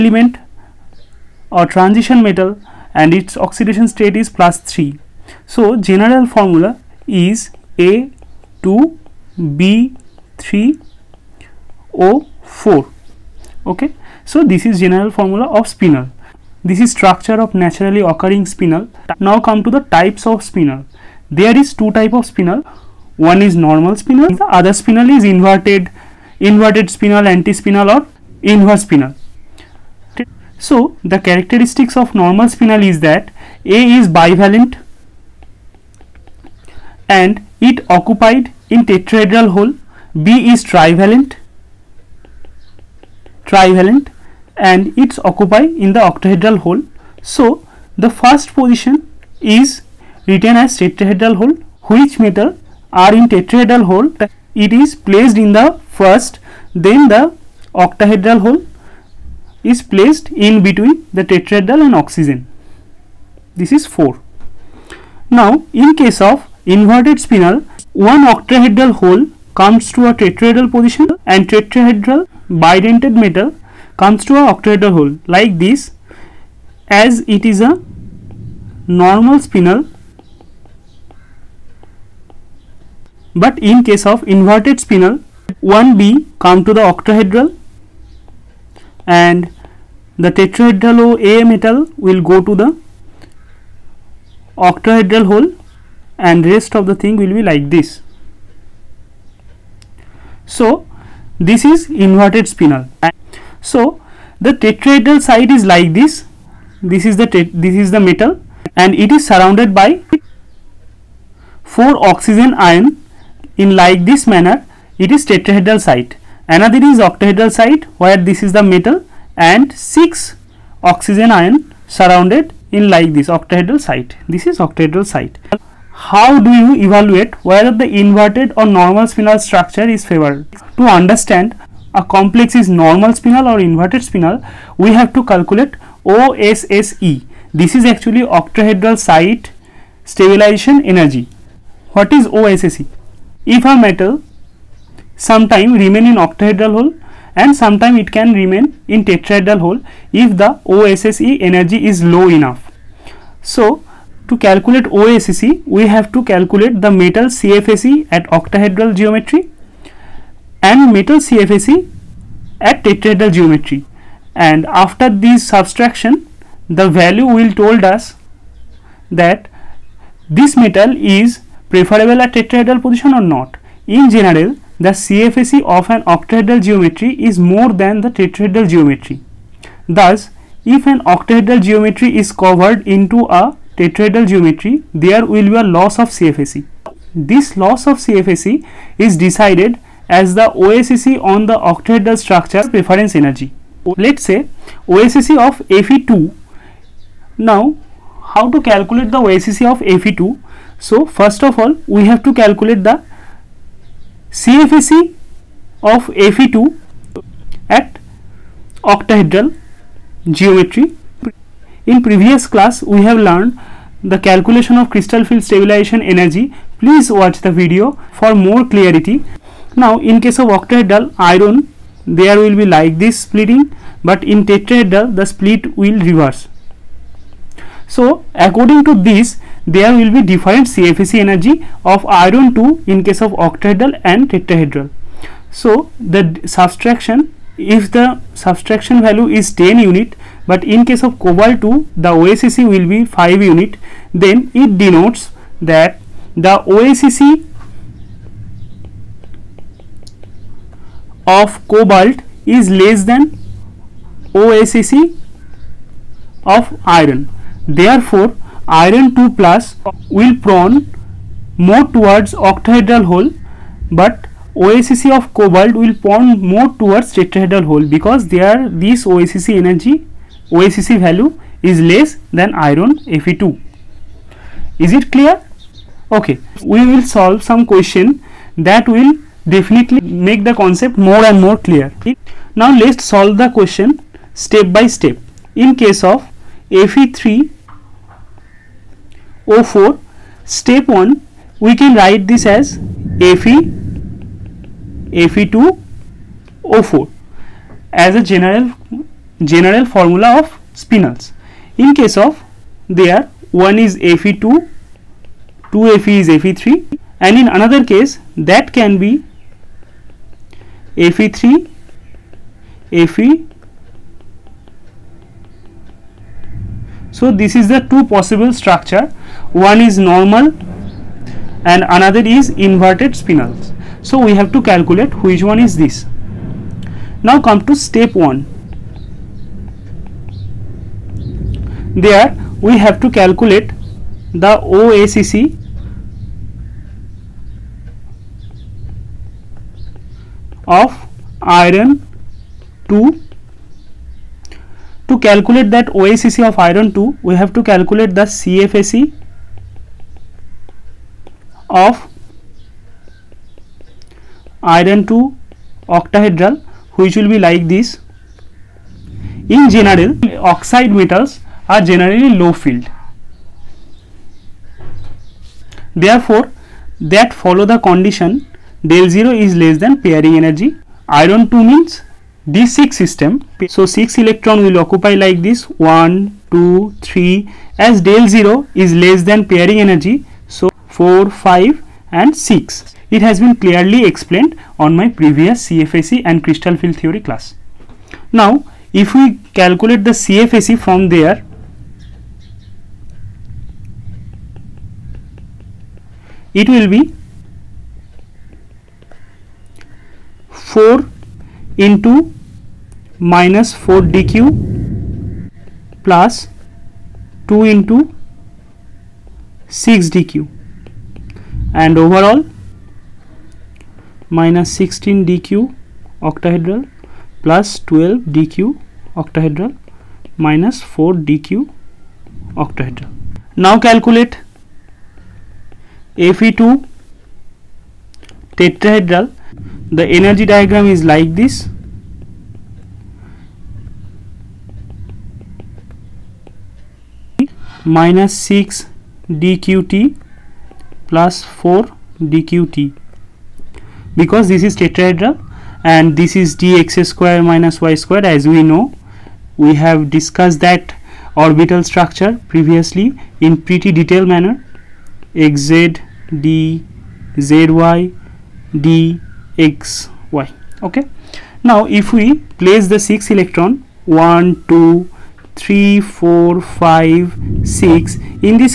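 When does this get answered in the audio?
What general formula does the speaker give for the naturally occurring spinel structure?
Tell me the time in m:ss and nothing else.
0:07.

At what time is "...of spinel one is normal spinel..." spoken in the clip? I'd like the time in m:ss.
0:22.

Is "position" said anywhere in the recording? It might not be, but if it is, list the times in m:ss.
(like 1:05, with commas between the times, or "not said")
0:48, 1:10, 2:52.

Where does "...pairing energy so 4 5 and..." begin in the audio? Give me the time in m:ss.
6:19.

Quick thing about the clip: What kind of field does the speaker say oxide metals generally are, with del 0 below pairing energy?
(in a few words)
low field.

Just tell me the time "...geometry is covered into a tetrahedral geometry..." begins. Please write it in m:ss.
3:01.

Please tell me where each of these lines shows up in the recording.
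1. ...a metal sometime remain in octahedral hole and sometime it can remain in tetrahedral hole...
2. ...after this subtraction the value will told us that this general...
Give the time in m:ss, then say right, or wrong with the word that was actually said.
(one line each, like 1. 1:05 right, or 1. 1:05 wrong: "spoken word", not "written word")
1. 2:23 right
2. 2:44 wrong: "metal", not "general".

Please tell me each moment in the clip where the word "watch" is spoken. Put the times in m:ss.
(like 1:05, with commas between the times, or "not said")
3:37.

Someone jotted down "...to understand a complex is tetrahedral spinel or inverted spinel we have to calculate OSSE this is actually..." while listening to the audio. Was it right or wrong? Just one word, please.
wrong.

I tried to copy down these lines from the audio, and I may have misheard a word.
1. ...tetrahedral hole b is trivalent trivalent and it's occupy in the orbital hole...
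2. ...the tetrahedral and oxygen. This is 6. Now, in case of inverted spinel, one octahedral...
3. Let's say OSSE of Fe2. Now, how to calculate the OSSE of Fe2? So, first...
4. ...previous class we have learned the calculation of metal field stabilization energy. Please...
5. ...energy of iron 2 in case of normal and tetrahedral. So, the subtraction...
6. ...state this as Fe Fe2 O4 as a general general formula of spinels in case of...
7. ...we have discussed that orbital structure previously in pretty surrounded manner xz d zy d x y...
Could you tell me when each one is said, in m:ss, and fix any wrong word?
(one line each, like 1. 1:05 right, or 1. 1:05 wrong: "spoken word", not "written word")
1. 0:38 wrong: "octahedral", not "orbital"
2. 1:01 wrong: "4", not "6"
3. 3:13 right
4. 3:32 wrong: "crystal", not "metal"
5. 3:51 wrong: "octahedral", not "normal"
6. 4:51 wrong: "write", not "state"
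7. 7:29 wrong: "detailed", not "surrounded".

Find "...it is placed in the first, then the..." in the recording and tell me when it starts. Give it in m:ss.
0:54.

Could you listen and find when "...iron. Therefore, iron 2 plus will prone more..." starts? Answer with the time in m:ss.
4:16.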